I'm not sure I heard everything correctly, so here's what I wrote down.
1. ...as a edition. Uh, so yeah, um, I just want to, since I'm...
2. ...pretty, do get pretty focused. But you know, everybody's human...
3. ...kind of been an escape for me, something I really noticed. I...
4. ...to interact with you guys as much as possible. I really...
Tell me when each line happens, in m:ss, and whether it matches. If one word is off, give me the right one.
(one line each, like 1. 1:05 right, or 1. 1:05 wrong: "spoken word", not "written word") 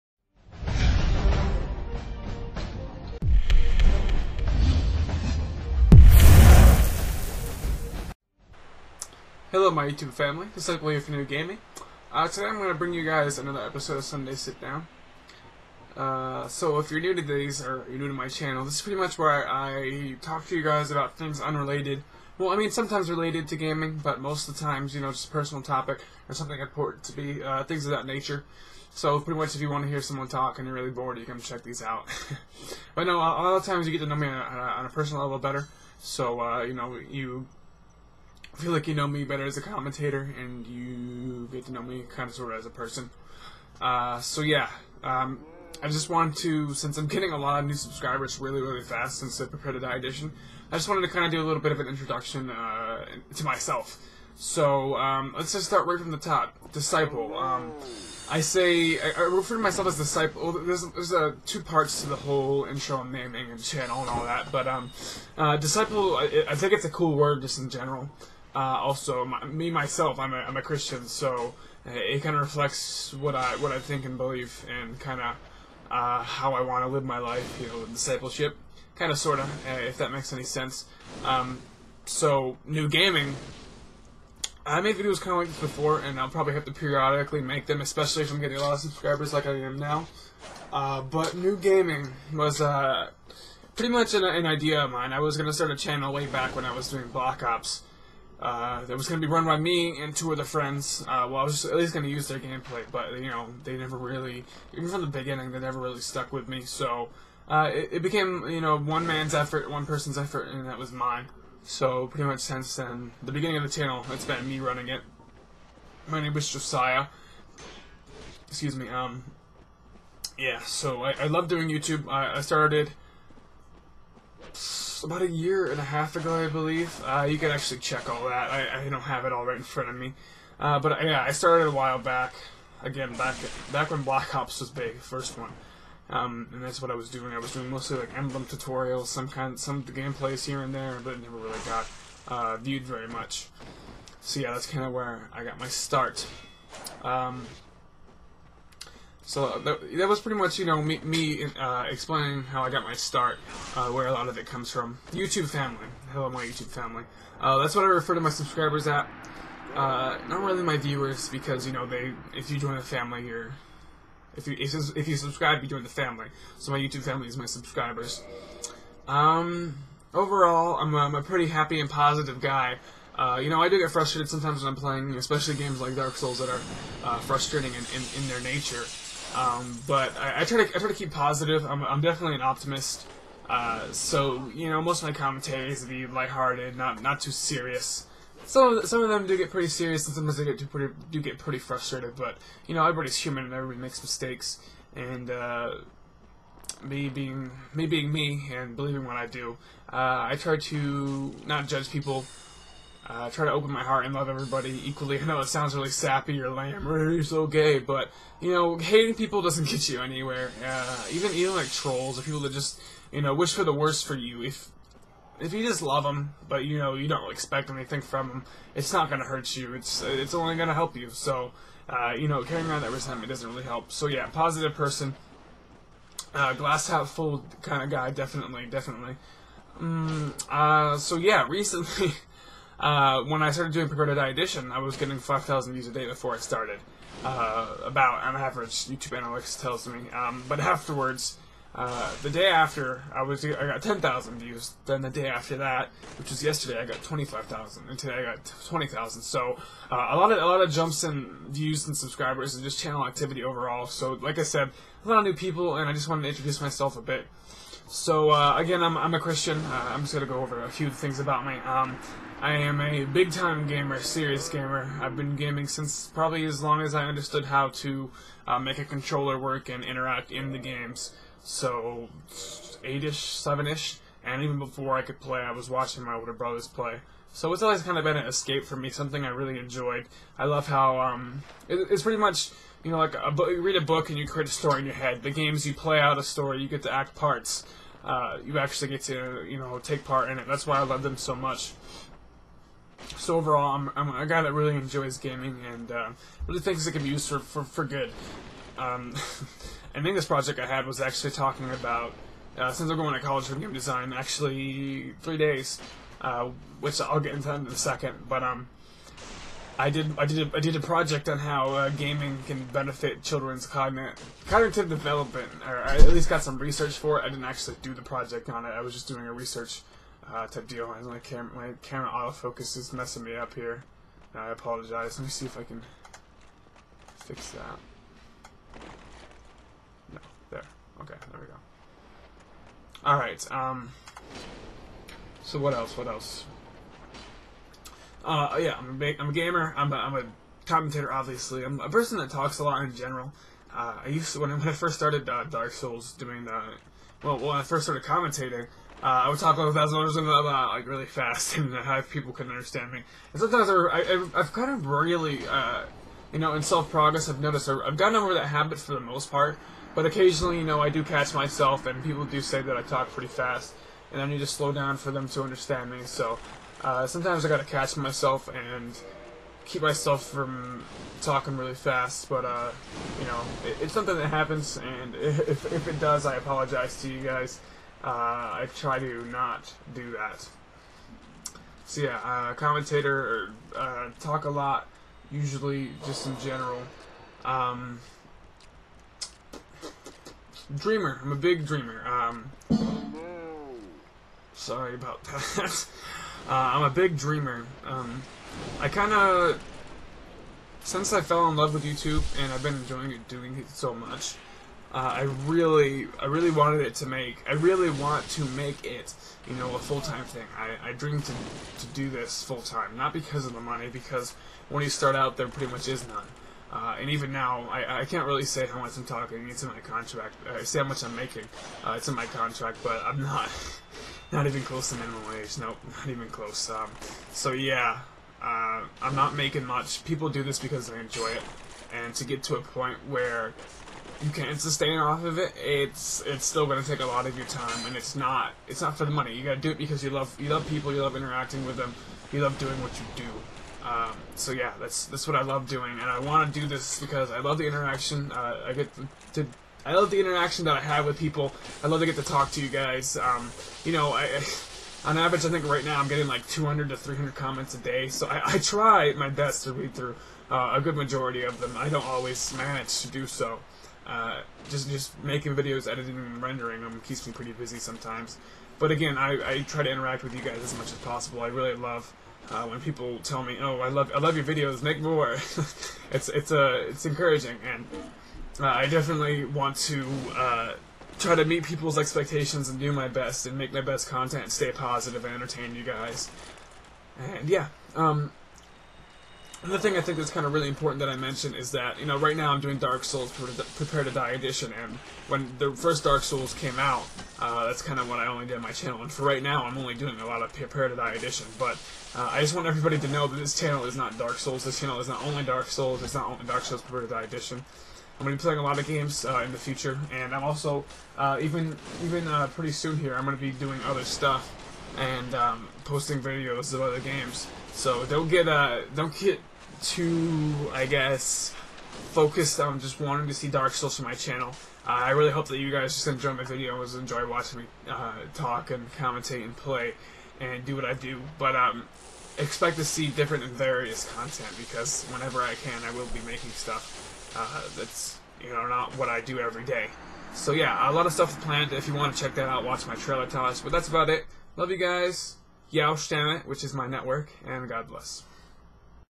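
1. 0:42 wrong: "person", not "edition"
2. 3:10 wrong: "frustrated", not "focused"
3. 4:37 wrong: "enjoyed", not "noticed"
4. 7:49 right.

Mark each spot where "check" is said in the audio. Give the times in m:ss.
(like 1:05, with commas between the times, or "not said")
0:31, 2:07, 9:02.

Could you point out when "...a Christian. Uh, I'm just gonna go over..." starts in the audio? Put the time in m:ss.
4:19.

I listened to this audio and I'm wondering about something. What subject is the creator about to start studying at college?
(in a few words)
game design.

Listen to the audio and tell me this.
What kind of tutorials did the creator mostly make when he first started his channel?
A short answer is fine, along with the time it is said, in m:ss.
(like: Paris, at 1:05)
emblem tutorials, at 2:18.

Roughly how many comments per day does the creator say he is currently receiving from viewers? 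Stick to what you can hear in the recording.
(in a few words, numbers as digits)
200 to 300.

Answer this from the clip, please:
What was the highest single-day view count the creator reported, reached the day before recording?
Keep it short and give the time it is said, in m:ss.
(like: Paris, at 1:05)
25,000, at 4:07.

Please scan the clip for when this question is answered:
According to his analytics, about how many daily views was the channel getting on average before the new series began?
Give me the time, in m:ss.
3:55.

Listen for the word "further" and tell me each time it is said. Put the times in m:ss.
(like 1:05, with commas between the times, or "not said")
not said.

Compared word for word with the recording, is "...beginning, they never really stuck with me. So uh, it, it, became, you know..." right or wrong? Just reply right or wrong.
right.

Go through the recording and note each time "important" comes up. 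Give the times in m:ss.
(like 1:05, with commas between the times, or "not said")
0:26, 8:10.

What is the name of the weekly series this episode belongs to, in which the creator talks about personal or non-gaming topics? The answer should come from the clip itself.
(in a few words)
Sunday Sit Down.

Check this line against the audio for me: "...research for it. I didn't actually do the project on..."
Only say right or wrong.
right.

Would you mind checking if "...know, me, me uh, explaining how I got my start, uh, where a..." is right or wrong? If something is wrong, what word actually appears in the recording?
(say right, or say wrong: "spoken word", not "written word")
right.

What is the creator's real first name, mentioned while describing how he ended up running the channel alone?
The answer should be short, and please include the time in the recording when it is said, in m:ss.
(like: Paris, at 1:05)
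Josiah, at 1:56.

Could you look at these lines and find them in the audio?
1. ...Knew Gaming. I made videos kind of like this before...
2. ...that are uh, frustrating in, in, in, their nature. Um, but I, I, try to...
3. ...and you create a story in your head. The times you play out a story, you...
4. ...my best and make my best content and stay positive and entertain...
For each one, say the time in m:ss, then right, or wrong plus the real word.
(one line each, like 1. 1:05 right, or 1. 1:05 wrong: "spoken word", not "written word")
1. 1:22 right
2. 2:56 right
3. 4:44 wrong: "games", not "times"
4. 8:02 right.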